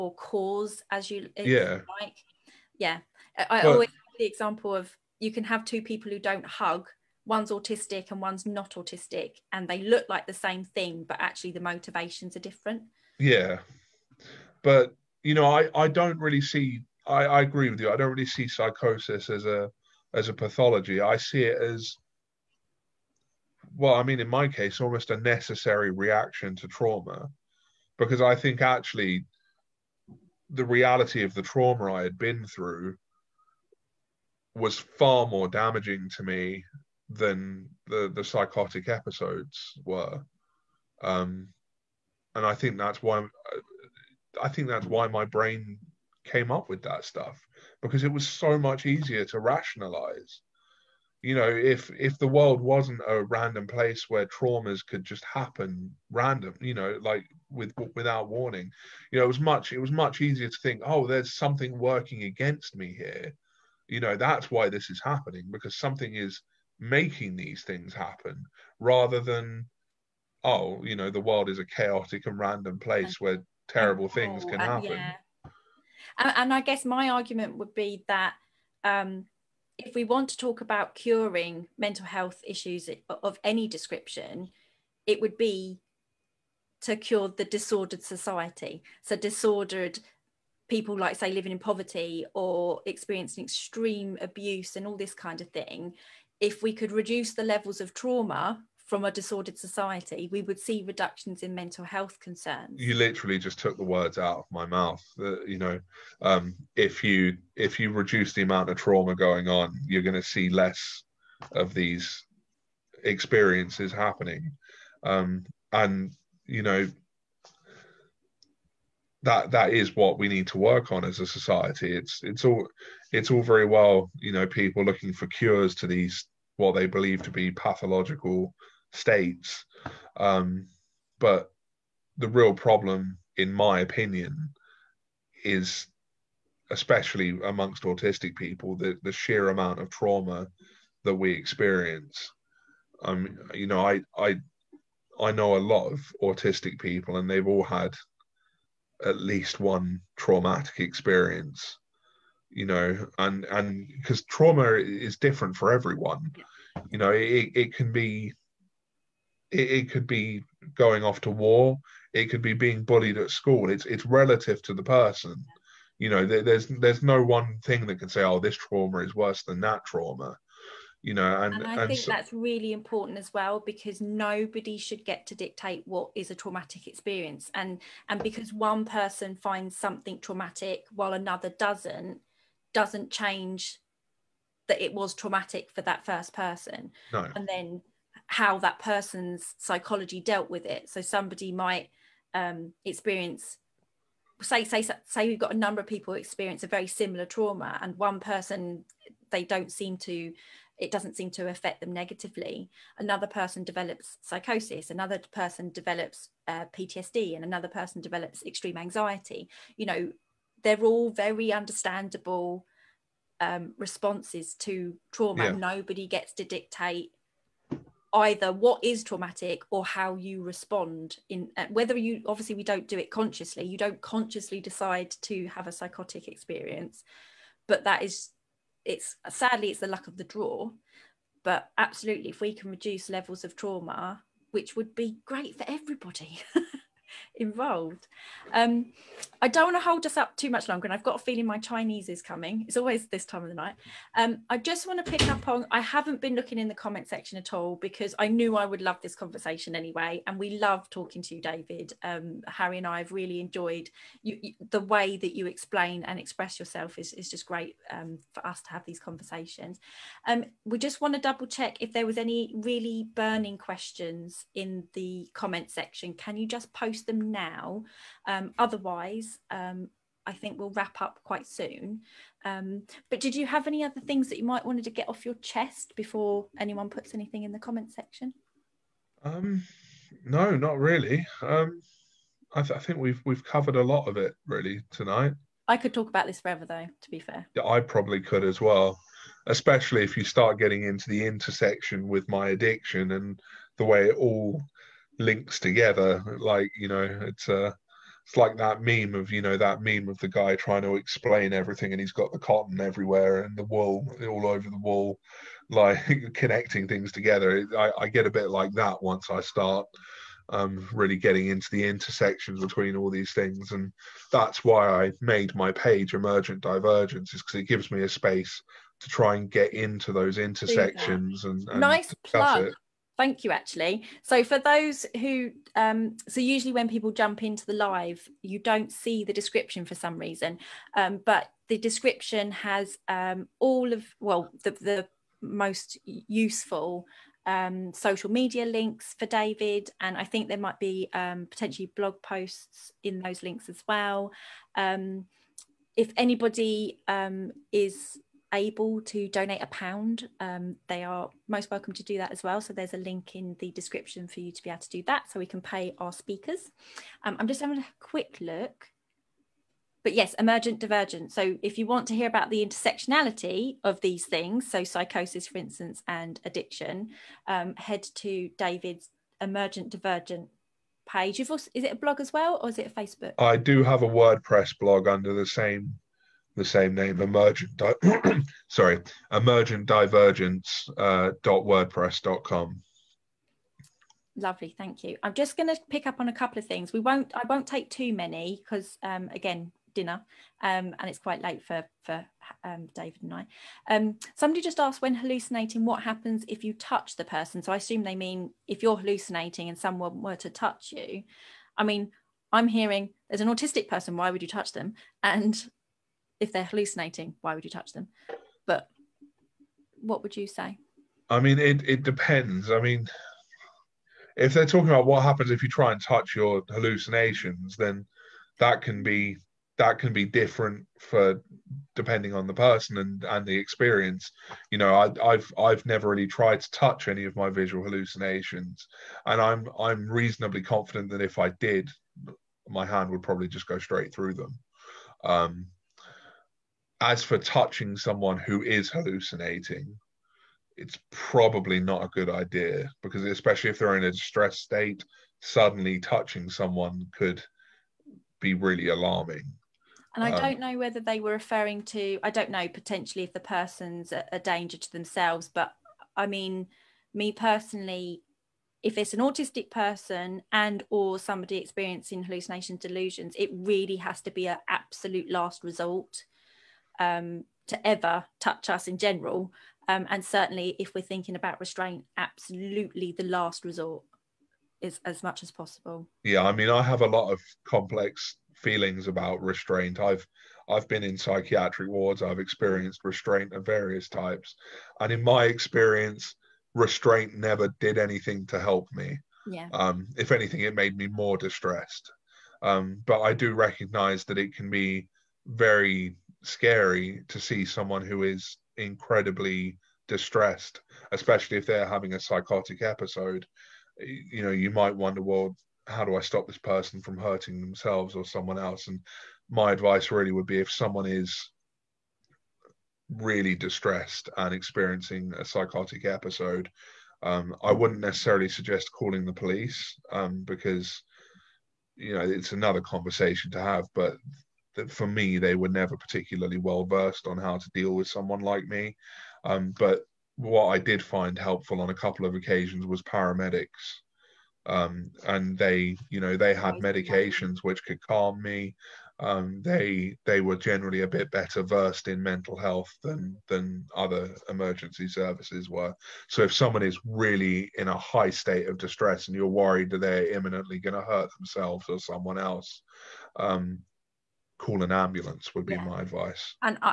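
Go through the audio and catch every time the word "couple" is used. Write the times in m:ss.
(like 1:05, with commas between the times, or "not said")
6:26, 8:51.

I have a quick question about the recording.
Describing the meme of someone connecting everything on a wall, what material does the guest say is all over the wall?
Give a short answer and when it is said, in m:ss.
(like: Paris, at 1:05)
wool, at 5:03.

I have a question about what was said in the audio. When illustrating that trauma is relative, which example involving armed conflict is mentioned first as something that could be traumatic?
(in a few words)
going off to war.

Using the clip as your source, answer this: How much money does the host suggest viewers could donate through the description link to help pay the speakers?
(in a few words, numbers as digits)
£1.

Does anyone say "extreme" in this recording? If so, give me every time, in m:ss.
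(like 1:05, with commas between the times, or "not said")
1:33, 3:28.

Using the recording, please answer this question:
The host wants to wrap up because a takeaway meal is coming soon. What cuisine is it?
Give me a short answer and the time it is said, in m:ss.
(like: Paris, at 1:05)
Chinese, at 4:01.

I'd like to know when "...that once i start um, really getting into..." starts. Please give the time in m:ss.
5:08.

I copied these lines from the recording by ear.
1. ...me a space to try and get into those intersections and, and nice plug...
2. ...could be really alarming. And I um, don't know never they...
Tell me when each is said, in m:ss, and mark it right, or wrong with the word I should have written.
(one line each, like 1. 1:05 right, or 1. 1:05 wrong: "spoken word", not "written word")
1. 5:17 right
2. 7:27 wrong: "whether", not "never".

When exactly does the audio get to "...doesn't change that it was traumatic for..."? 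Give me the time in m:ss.
3:02.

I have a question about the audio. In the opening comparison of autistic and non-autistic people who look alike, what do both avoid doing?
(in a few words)
hug.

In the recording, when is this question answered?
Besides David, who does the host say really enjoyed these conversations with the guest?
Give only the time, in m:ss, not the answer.
4:12.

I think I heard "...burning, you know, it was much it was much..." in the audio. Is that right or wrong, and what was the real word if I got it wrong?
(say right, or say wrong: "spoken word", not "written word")
wrong: "warning", not "burning".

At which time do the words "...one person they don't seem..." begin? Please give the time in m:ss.
3:17.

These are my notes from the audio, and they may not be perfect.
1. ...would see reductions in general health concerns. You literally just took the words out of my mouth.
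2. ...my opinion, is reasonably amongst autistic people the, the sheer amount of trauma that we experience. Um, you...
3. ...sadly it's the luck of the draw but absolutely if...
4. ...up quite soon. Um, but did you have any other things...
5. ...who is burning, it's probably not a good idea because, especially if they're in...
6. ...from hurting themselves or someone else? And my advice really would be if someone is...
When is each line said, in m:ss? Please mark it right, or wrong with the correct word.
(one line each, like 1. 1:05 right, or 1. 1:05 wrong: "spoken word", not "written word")
1. 1:40 wrong: "mental", not "general"
2. 2:13 wrong: "especially", not "reasonably"
3. 3:49 right
4. 4:31 right
5. 7:18 wrong: "hallucinating", not "burning"
6. 8:27 right.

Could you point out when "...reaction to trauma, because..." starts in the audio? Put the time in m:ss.
0:25.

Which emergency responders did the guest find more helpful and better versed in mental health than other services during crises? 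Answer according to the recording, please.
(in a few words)
paramedics.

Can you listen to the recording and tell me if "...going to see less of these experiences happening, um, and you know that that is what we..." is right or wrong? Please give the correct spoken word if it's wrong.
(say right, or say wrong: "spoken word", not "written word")
right.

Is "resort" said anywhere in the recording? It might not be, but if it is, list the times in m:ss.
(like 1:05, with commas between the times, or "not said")
7:45, 7:53.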